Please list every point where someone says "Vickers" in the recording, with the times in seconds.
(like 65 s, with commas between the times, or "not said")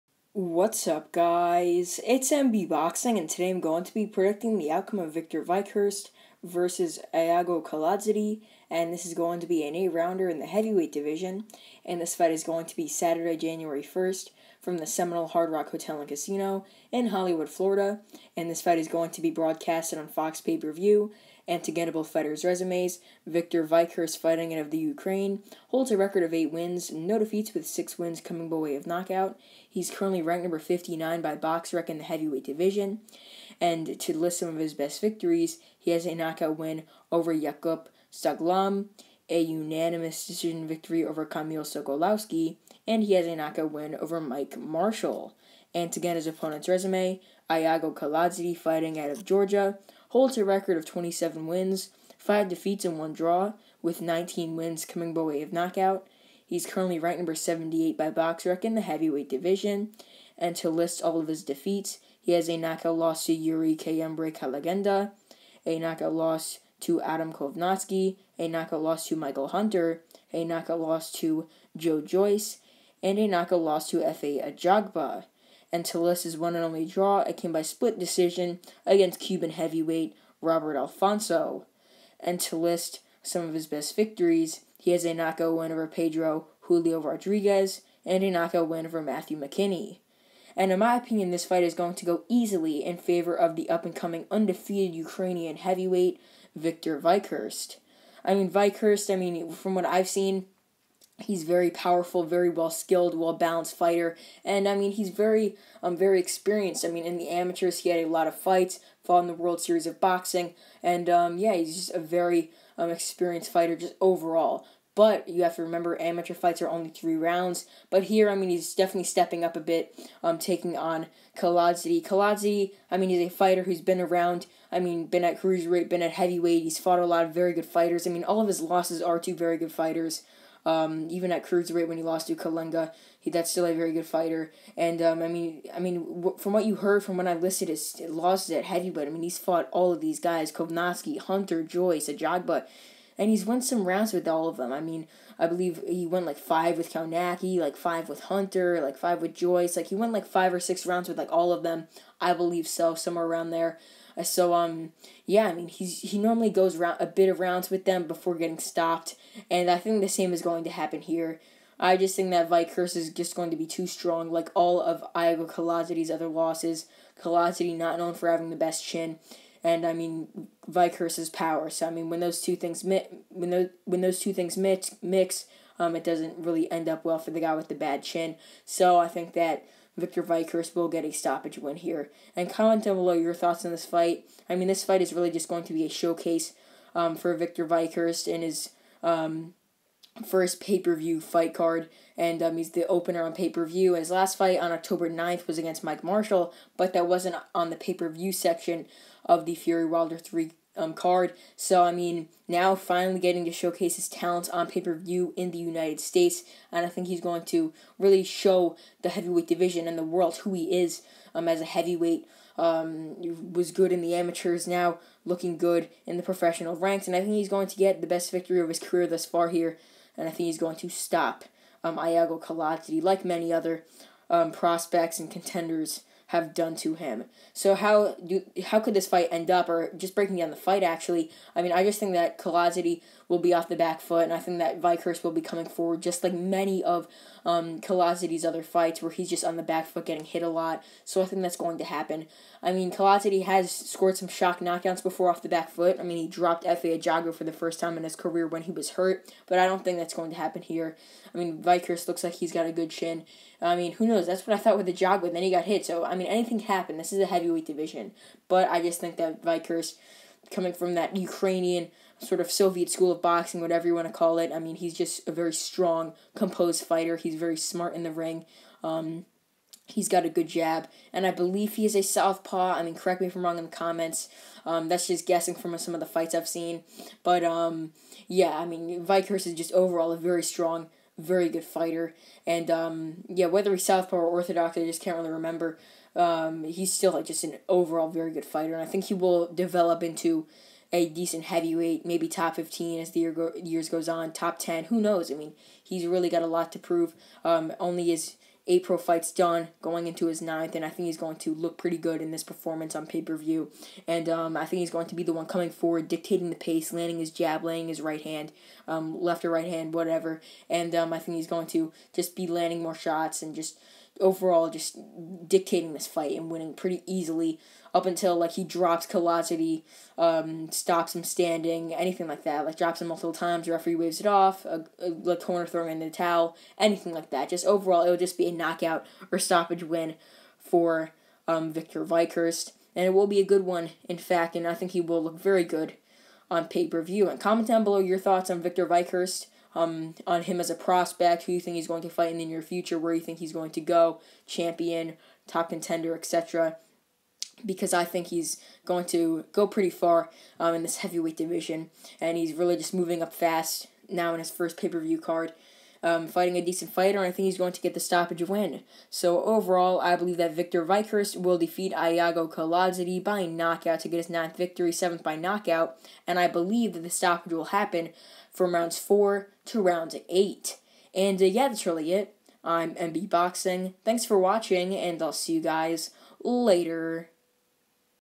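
259 s, 279 s.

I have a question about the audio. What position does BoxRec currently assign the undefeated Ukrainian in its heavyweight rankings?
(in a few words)
59.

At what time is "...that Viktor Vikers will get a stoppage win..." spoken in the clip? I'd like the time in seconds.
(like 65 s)
179 s.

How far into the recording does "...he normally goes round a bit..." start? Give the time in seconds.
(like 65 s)
156 s.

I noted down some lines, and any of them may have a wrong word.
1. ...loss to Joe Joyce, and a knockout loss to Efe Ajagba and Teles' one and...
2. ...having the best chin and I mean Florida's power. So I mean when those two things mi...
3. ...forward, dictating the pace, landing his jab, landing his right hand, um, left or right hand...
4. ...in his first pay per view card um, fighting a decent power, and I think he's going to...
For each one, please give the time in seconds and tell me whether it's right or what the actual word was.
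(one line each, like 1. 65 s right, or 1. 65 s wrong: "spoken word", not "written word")
1. 70 s right
2. 168 s wrong: "Viker", not "Florida"
3. 305 s right
4. 354 s wrong: "fighter", not "power".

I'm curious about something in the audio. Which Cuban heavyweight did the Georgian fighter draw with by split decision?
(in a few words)
Robert Alfonso.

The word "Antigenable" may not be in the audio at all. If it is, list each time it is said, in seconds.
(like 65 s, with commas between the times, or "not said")
21 s.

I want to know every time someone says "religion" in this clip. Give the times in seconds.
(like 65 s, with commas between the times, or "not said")
not said.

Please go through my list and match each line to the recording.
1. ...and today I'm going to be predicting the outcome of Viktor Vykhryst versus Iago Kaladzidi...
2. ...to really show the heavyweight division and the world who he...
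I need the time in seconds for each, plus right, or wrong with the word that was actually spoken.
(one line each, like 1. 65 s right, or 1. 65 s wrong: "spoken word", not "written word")
1. 3 s right
2. 207 s right.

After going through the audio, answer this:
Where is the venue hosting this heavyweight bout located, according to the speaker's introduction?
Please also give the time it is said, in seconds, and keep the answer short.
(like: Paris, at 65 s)
Hollywood, Florida, at 17 s.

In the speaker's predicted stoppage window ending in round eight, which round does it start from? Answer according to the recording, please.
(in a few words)
4.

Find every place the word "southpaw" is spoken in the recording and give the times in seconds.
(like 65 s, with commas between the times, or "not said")
272 s, 283 s.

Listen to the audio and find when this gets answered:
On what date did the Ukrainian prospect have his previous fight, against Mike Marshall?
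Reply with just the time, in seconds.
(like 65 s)
194 s.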